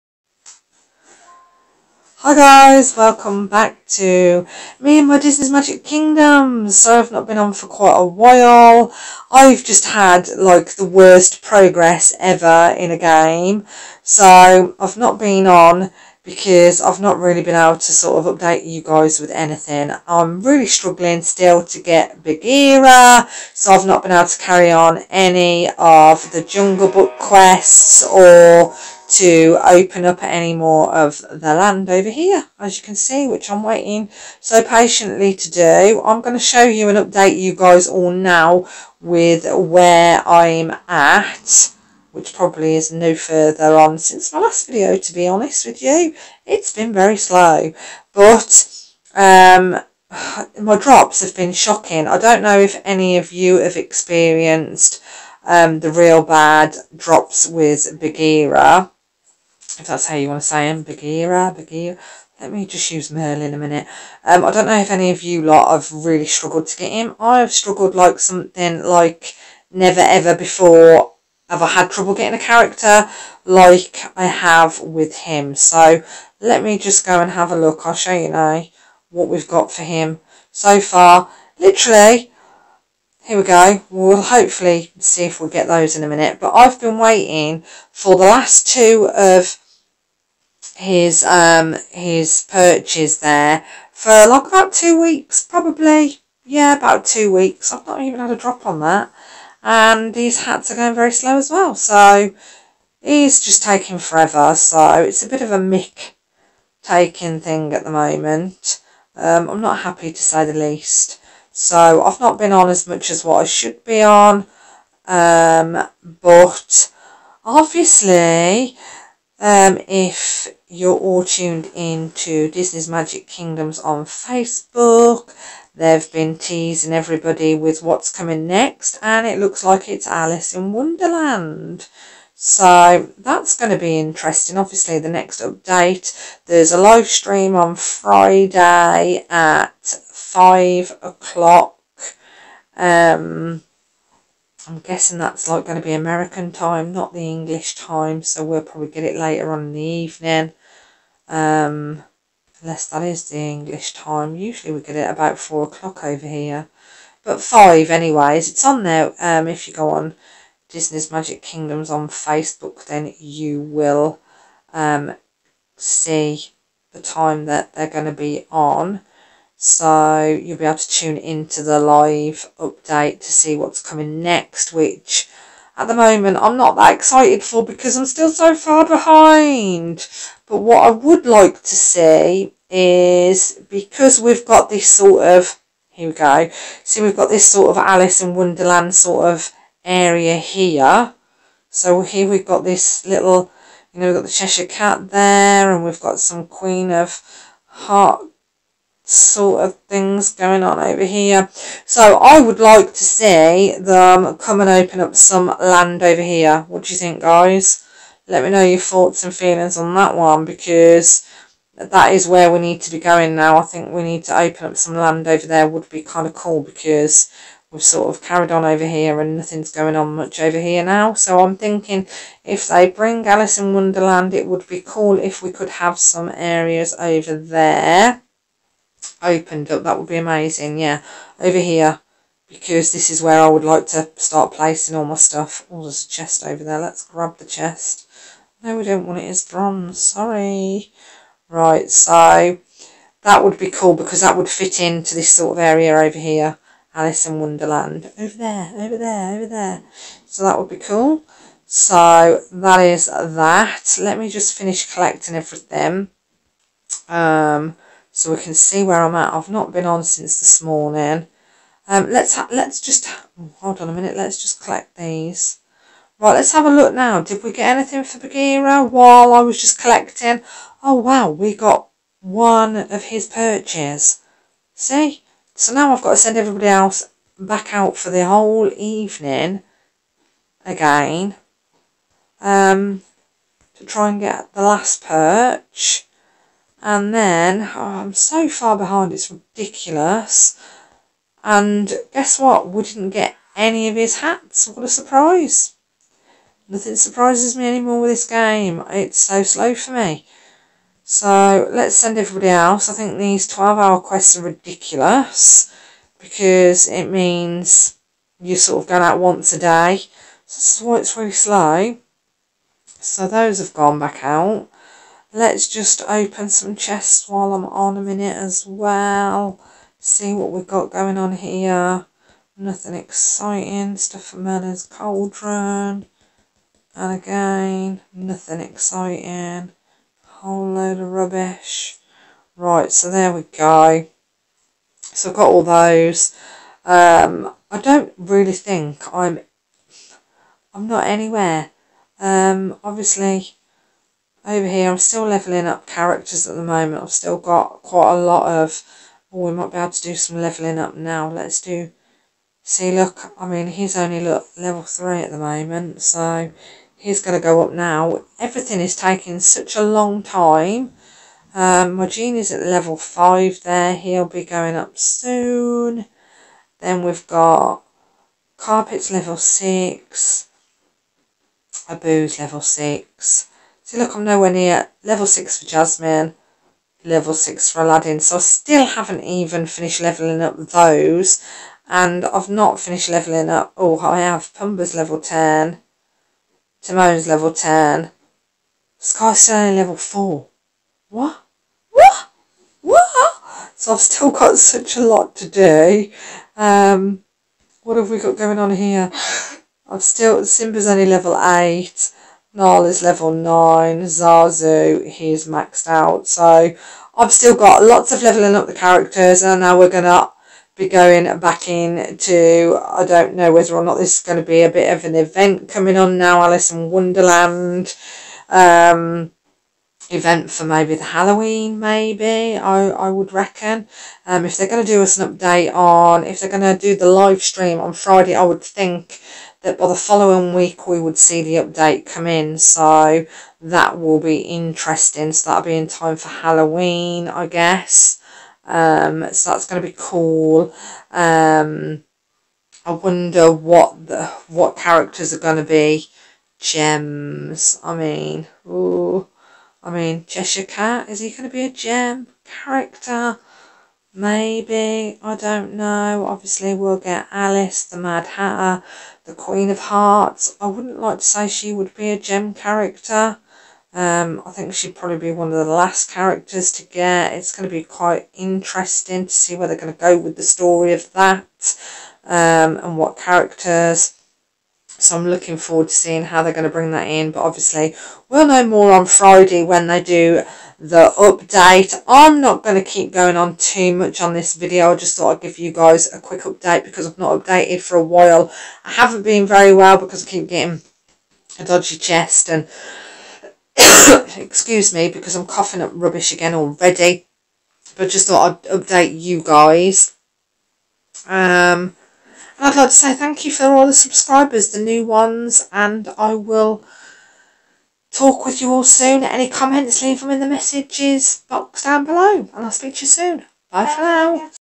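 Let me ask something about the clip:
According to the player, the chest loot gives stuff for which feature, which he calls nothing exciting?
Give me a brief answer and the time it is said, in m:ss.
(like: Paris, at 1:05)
Merlin's Cauldron, at 5:24.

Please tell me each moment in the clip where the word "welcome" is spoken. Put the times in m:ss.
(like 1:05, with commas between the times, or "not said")
0:02.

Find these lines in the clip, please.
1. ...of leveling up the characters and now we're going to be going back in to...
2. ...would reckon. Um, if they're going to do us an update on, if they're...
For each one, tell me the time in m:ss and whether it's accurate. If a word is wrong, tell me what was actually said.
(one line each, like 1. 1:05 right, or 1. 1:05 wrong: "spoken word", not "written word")
1. 6:48 right
2. 7:03 right.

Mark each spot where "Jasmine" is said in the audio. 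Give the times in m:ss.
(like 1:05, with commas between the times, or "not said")
6:15.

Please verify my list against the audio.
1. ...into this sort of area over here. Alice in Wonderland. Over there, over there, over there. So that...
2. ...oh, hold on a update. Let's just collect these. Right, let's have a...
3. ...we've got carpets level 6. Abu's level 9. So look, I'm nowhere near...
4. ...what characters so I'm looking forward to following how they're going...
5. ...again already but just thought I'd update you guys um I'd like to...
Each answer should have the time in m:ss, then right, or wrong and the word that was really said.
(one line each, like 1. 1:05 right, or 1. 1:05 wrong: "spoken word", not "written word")
1. 4:04 right
2. 4:23 wrong: "minute", not "update"
3. 6:07 wrong: "6", not "9"
4. 7:52 wrong: "seeing", not "following"
5. 8:16 right.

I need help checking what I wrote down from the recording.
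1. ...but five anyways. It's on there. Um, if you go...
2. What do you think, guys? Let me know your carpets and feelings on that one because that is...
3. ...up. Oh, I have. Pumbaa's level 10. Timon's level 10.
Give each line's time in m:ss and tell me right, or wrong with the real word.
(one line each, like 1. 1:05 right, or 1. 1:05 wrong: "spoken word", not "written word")
1. 2:37 right
2. 3:26 wrong: "thoughts", not "carpets"
3. 6:23 right.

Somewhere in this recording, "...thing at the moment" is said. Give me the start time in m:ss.
1:47.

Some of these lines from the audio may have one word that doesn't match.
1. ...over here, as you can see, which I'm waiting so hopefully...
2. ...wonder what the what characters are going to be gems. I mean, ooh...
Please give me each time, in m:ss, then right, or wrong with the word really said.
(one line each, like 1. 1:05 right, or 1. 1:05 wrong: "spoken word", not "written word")
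1. 0:31 wrong: "patiently", not "hopefully"
2. 7:22 right.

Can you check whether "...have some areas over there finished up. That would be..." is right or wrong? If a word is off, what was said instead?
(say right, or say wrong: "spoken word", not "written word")
wrong: "opened", not "finished".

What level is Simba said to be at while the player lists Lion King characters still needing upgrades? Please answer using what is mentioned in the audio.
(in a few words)
8.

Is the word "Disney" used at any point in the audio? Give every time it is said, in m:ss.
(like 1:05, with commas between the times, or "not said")
0:05, 2:02, 2:40.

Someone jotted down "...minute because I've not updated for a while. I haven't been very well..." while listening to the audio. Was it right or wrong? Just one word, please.
wrong.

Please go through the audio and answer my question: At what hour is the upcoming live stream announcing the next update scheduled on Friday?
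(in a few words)
5 o'clock.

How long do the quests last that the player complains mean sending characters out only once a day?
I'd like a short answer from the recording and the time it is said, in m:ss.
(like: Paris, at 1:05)
12 hours, at 5:03.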